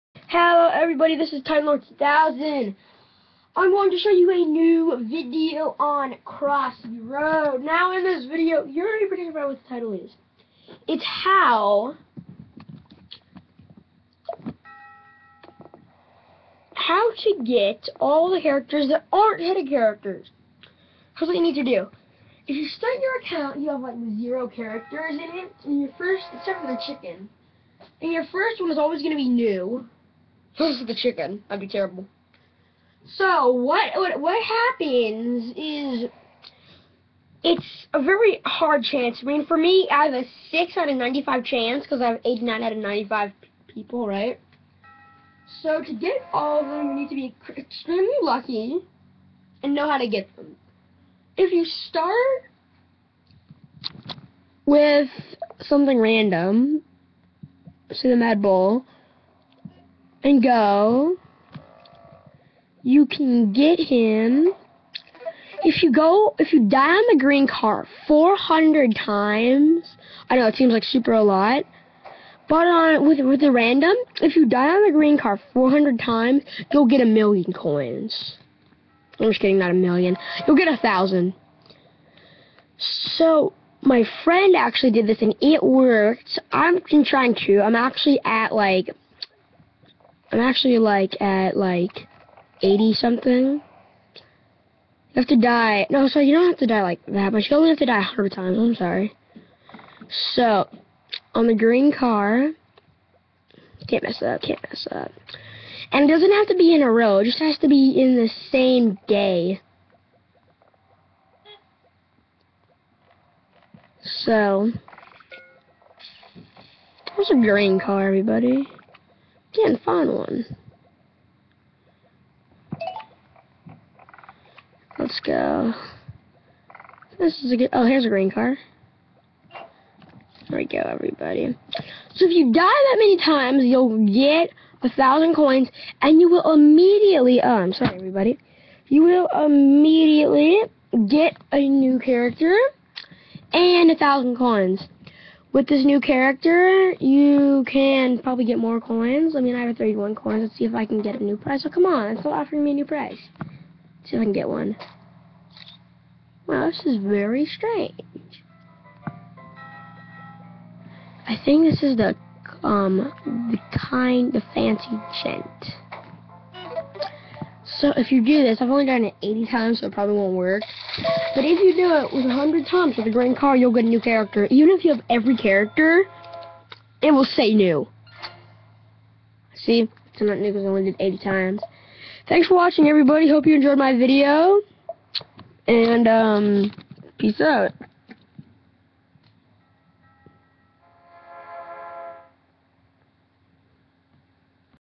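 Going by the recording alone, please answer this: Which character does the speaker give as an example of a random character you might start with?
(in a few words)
Mad Bull.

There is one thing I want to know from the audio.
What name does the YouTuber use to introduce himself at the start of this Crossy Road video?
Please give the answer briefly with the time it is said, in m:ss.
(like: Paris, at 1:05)
Time Lord 2000, at 0:01.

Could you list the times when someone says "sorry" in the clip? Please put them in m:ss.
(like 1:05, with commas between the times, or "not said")
1:38, 2:17.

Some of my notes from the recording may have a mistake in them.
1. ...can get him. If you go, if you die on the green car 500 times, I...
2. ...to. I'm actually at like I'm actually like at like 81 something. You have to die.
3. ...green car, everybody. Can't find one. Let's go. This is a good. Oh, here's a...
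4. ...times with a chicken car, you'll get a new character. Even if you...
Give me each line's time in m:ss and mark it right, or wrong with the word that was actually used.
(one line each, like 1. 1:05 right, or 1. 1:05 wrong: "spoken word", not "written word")
1. 1:03 wrong: "400", not "500"
2. 1:27 wrong: "80", not "81"
3. 1:57 right
4. 2:52 wrong: "green", not "chicken".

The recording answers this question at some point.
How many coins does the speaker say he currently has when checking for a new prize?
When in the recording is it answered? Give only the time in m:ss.
2:29.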